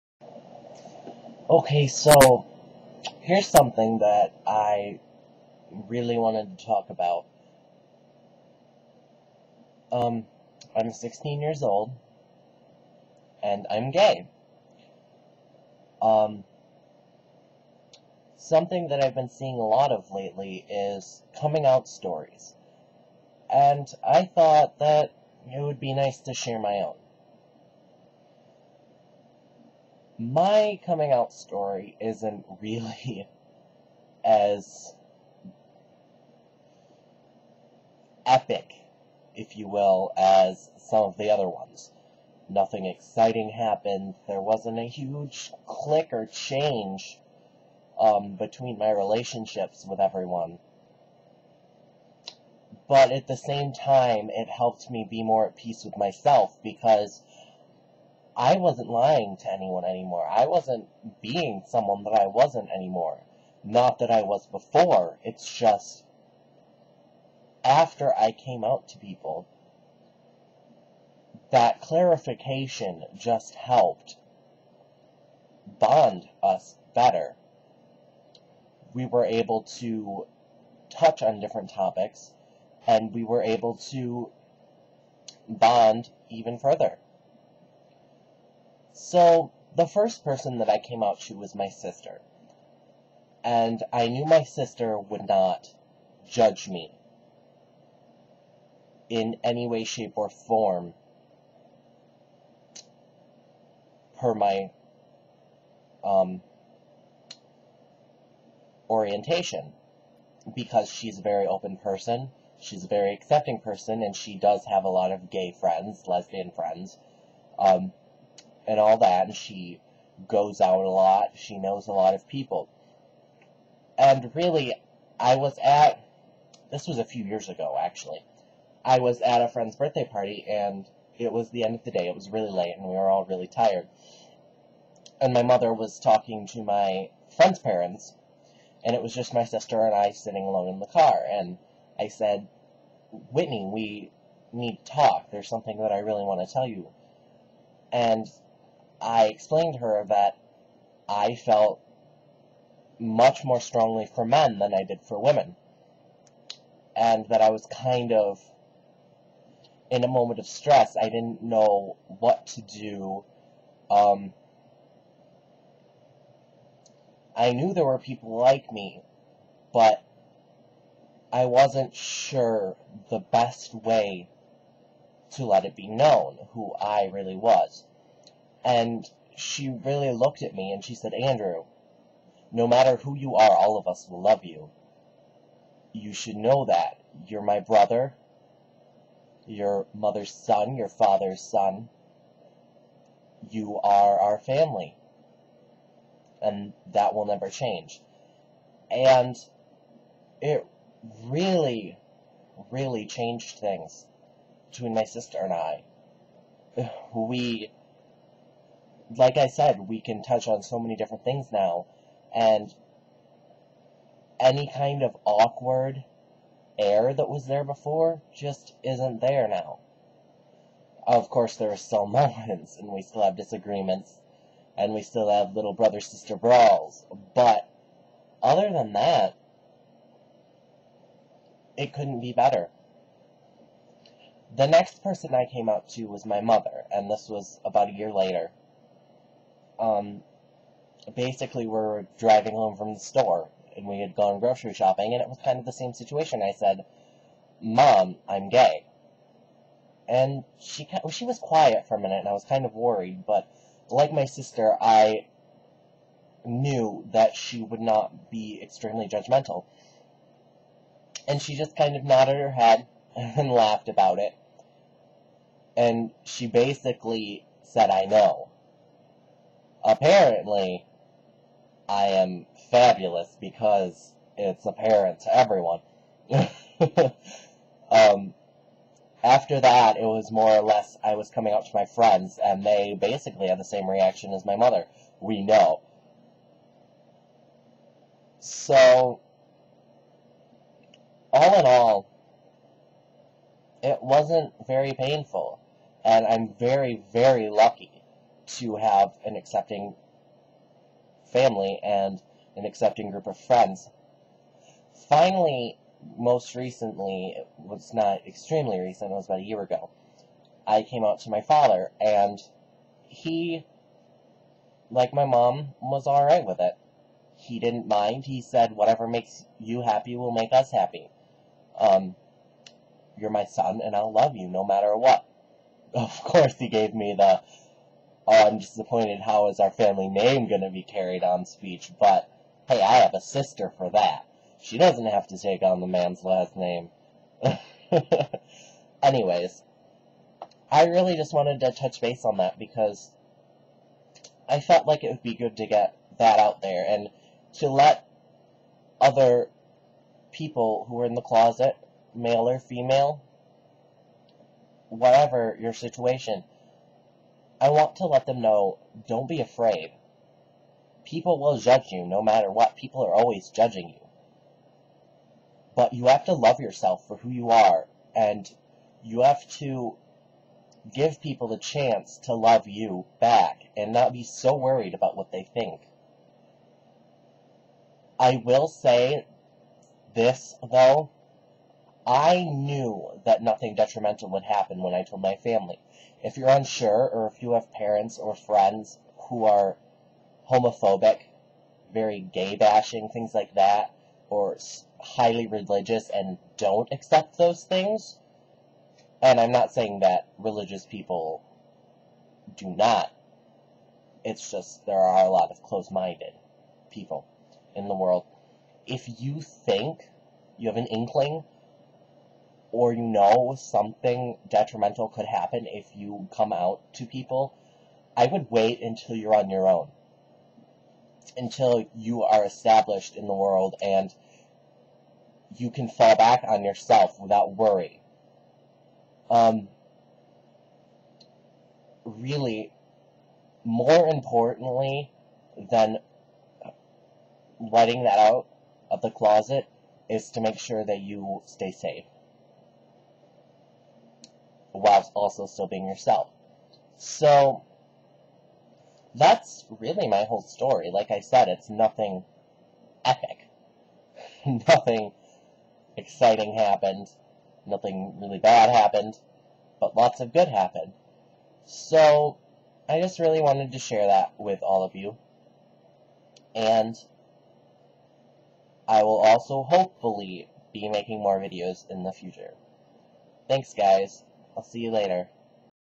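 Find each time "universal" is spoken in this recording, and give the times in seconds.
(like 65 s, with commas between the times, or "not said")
not said.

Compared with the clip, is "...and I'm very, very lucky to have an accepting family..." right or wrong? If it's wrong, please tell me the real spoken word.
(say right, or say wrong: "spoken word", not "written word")
right.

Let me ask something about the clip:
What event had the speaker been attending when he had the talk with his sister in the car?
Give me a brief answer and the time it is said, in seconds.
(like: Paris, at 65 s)
A friend's birthday party, at 129 s.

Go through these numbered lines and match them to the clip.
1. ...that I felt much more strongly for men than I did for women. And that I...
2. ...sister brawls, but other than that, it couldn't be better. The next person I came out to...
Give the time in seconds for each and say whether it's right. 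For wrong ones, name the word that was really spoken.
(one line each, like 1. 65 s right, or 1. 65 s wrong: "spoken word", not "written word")
1. 150 s right
2. 225 s right.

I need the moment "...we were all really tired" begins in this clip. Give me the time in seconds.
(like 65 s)
132 s.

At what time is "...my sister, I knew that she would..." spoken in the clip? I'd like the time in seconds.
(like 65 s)
254 s.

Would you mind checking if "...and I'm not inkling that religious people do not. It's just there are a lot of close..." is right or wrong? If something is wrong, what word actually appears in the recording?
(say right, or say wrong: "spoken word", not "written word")
wrong: "saying", not "inkling".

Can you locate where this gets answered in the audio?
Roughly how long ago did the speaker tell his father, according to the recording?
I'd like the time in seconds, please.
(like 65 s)
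309 s.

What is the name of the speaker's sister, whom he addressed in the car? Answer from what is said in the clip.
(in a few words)
Whitney.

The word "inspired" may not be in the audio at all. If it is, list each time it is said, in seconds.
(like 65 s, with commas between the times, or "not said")
not said.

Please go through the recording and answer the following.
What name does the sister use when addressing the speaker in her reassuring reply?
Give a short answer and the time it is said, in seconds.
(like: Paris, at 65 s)
Andrew, at 181 s.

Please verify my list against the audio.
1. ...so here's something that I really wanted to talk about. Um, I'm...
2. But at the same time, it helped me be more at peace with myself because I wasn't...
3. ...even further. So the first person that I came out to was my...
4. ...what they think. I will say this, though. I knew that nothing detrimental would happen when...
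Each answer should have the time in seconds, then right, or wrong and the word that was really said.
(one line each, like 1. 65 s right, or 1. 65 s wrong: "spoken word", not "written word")
1. 1 s right
2. 52 s right
3. 86 s right
4. 375 s right.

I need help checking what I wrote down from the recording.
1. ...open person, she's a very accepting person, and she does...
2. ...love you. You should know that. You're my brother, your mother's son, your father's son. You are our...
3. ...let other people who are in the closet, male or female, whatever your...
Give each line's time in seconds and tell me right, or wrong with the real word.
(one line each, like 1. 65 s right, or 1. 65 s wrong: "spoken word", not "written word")
1. 111 s right
2. 184 s right
3. 347 s right.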